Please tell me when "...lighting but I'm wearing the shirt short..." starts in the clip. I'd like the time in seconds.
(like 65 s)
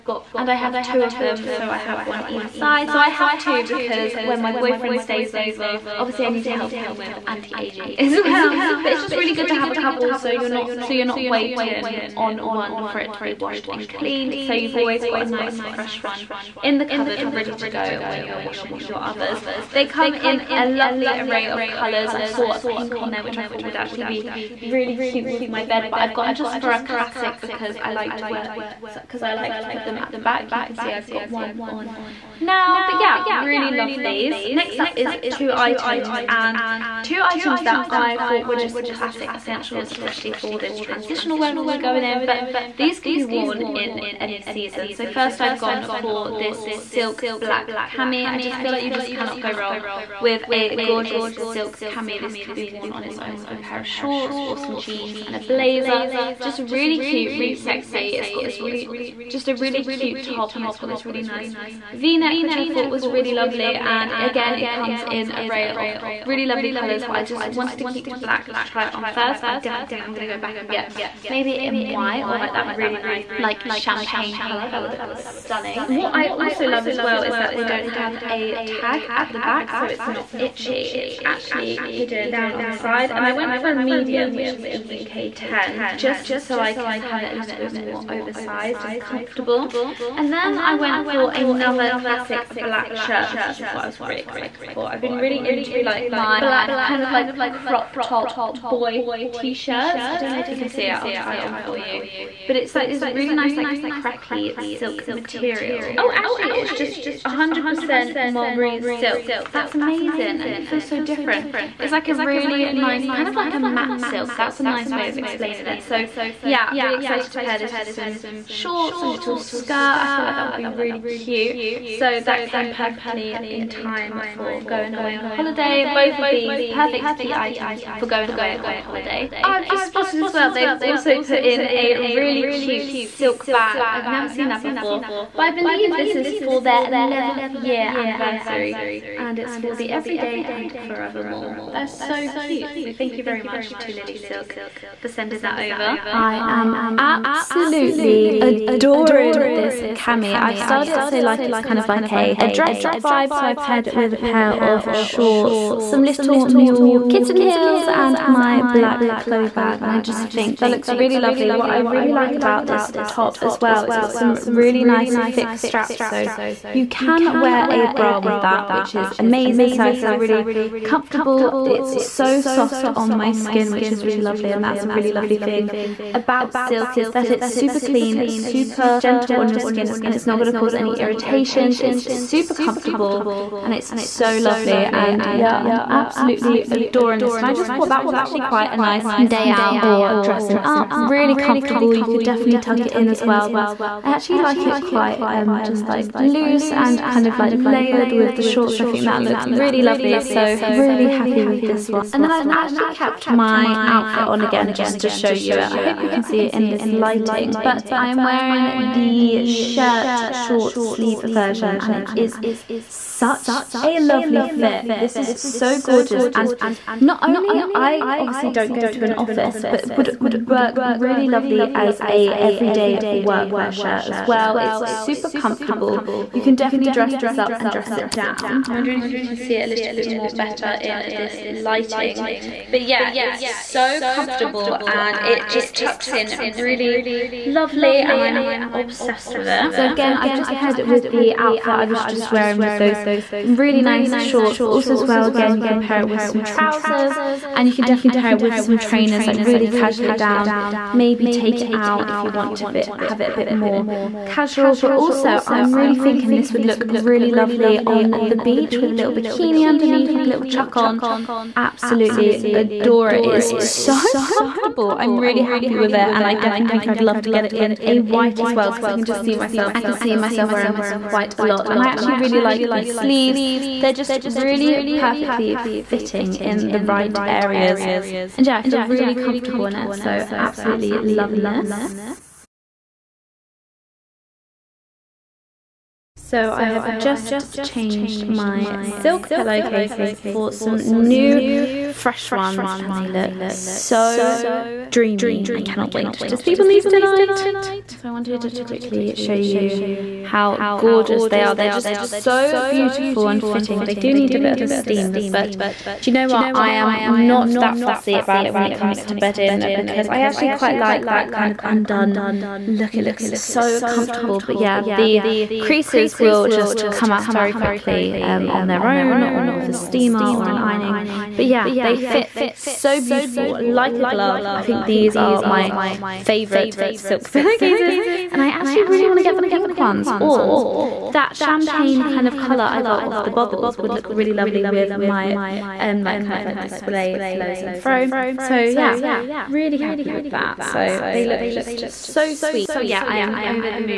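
206 s.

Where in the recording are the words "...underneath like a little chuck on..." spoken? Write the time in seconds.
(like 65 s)
259 s.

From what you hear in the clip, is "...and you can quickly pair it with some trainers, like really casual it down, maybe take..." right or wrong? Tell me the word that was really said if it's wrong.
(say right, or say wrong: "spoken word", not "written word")
wrong: "definitely", not "quickly".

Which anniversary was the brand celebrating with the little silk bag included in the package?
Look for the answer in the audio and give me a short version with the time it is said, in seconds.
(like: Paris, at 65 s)
11th, at 137 s.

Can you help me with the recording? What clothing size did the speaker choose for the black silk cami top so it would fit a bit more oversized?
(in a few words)
UK 10.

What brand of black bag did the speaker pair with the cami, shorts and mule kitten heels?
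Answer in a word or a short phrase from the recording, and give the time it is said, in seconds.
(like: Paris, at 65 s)
Chloe, at 159 s.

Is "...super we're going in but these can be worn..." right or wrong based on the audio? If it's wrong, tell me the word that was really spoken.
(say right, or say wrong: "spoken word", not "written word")
wrong: "weather", not "super".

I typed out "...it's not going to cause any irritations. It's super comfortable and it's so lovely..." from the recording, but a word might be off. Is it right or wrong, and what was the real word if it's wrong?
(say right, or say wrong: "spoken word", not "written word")
right.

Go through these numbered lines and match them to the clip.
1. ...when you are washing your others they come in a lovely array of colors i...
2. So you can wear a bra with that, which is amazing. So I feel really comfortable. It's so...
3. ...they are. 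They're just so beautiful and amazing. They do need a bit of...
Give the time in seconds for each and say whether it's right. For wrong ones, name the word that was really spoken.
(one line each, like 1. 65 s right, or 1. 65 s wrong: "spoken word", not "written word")
1. 18 s right
2. 166 s right
3. 301 s wrong: "fitting", not "amazing".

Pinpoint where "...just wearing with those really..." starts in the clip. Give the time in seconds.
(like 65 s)
242 s.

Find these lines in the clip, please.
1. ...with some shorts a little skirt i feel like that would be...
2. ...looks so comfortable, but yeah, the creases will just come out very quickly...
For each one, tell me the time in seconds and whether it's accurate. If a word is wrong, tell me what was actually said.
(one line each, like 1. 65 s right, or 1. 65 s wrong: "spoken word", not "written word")
1. 117 s right
2. 313 s right.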